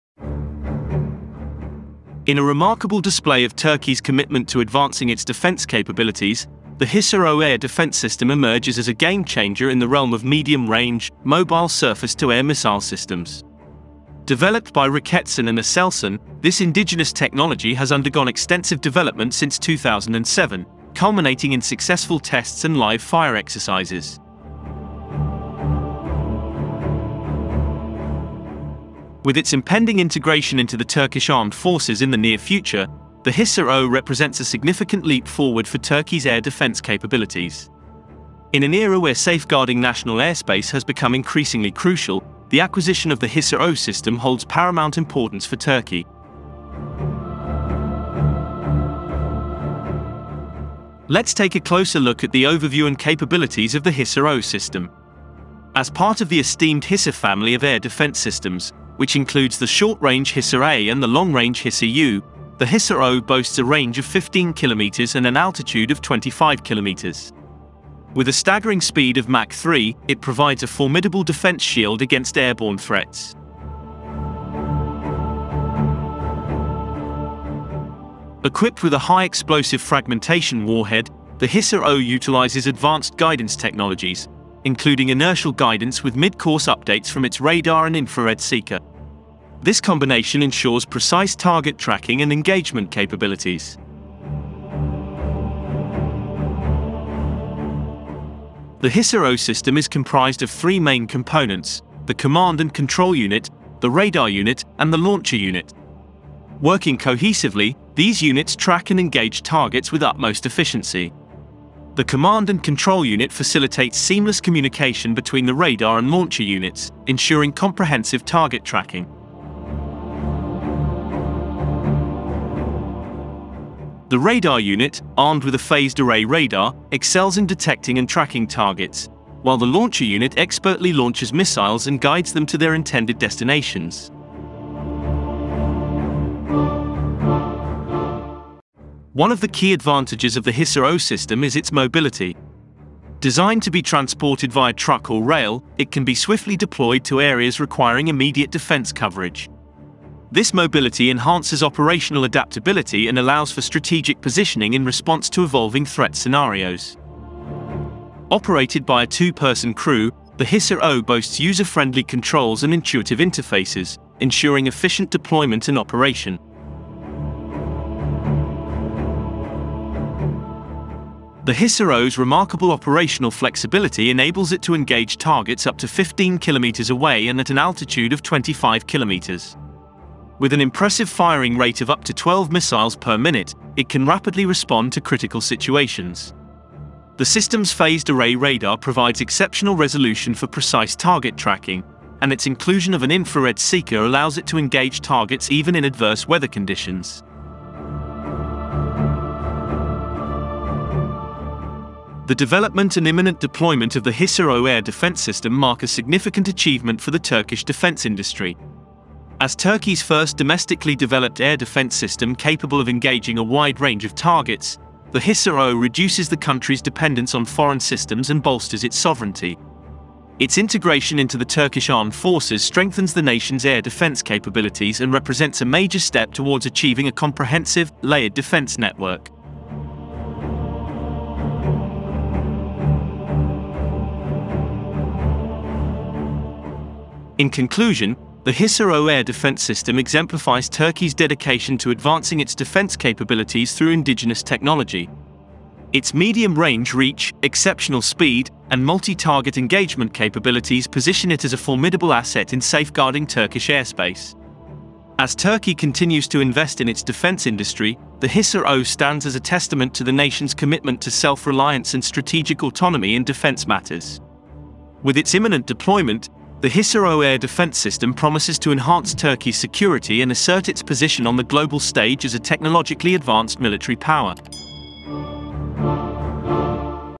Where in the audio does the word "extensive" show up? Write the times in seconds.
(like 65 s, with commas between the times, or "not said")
18 s.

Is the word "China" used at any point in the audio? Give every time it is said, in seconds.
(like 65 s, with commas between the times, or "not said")
not said.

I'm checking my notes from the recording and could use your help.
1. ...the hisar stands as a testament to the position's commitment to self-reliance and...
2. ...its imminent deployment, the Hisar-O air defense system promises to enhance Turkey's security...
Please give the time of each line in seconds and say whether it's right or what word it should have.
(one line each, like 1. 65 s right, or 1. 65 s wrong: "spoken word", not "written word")
1. 258 s wrong: "nation", not "position"
2. 265 s right.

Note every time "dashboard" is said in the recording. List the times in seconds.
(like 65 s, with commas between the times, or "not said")
not said.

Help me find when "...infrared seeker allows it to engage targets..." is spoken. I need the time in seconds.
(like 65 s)
193 s.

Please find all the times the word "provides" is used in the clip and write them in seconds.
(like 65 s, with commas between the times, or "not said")
70 s, 188 s.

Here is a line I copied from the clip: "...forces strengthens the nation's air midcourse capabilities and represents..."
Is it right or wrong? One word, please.
wrong.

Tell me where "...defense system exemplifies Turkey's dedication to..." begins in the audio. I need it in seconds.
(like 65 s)
239 s.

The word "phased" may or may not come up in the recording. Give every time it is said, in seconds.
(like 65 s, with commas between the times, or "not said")
125 s, 187 s.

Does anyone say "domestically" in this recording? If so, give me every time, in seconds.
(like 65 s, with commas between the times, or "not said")
210 s.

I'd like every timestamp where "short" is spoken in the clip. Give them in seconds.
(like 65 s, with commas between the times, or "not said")
59 s.